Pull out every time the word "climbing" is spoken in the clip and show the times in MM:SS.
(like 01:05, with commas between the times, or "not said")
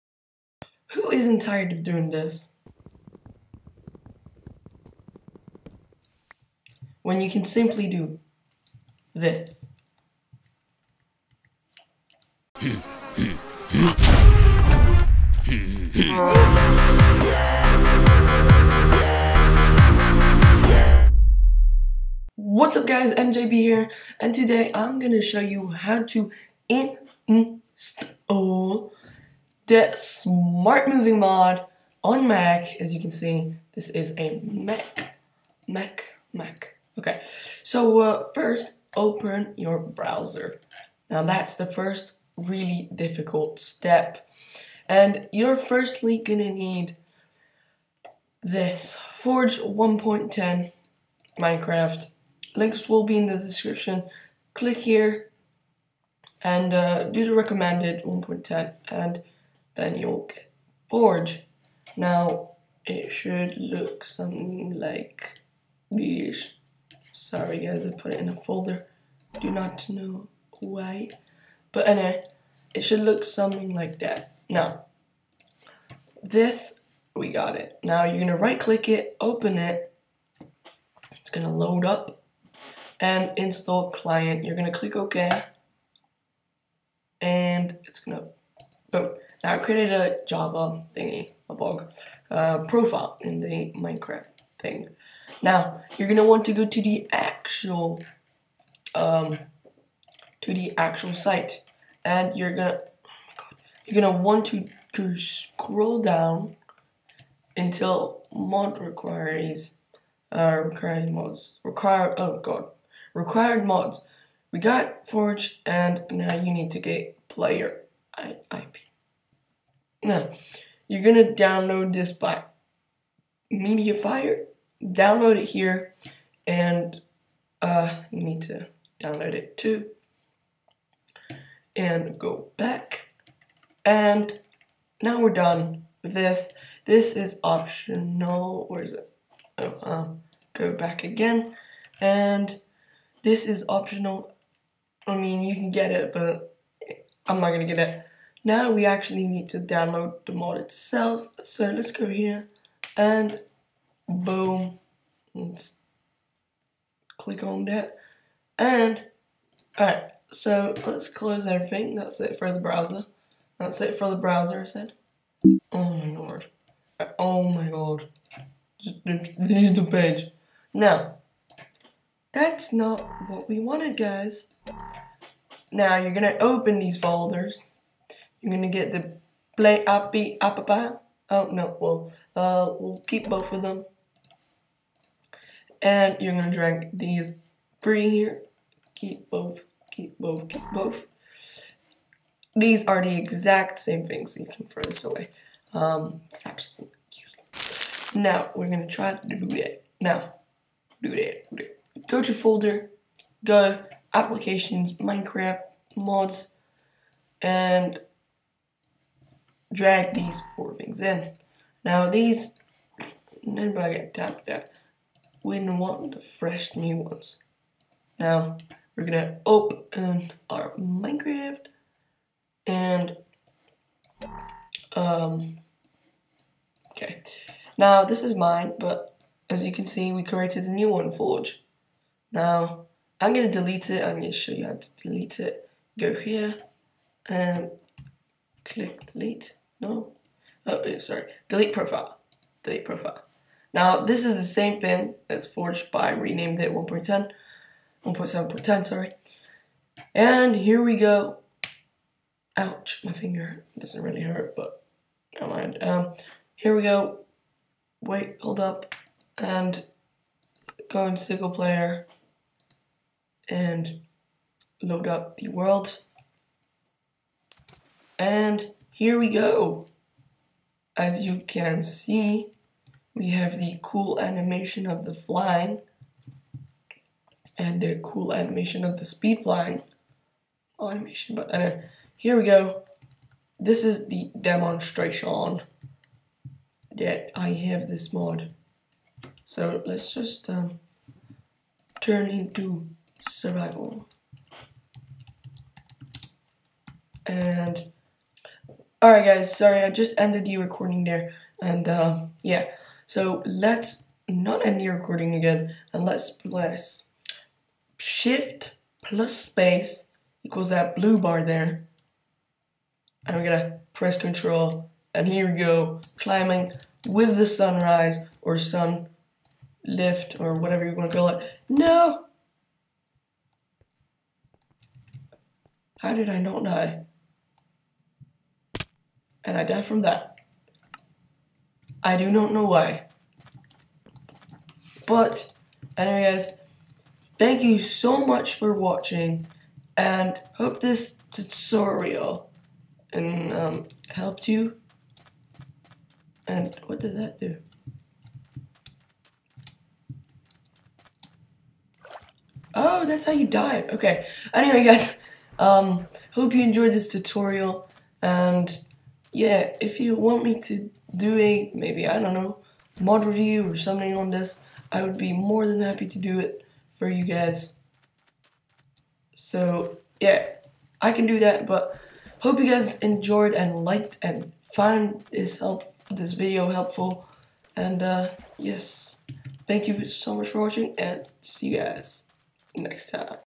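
05:16.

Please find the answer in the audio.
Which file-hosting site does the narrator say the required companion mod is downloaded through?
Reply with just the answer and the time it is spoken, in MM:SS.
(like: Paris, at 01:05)
MediaFire, at 02:03.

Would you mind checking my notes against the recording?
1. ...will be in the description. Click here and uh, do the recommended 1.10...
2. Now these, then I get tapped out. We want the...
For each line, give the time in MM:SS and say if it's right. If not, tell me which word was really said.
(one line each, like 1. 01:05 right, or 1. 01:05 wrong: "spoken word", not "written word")
1. 00:52 right
2. 03:31 right.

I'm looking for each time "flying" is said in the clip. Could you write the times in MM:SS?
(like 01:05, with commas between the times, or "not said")
04:35, 04:39.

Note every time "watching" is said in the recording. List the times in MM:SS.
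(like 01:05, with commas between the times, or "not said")
05:38, 06:20.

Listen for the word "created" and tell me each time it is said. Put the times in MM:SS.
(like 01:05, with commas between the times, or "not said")
01:29, 03:50.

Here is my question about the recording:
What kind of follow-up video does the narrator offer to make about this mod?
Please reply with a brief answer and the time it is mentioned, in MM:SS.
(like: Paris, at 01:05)
mod review, at 06:02.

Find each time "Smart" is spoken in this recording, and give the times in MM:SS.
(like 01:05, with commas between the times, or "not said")
00:29.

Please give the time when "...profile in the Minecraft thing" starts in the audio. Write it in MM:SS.
01:32.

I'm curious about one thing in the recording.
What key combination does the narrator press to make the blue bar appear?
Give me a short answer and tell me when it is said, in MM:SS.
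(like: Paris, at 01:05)
shift plus space, at 05:07.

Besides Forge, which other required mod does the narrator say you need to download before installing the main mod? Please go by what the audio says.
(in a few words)
Player API.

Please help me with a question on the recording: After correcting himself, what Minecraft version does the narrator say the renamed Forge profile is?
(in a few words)
1.7.10.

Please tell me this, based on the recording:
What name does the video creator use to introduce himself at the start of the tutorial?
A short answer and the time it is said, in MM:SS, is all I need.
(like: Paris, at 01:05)
MJB, at 00:23.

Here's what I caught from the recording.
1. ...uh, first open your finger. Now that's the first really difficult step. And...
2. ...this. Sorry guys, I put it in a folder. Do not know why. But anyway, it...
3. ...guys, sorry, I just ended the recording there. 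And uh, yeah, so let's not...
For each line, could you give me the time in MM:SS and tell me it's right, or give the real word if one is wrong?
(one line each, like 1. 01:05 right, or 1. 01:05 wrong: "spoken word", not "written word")
1. 00:38 wrong: "browser", not "finger"
2. 01:05 right
3. 04:59 right.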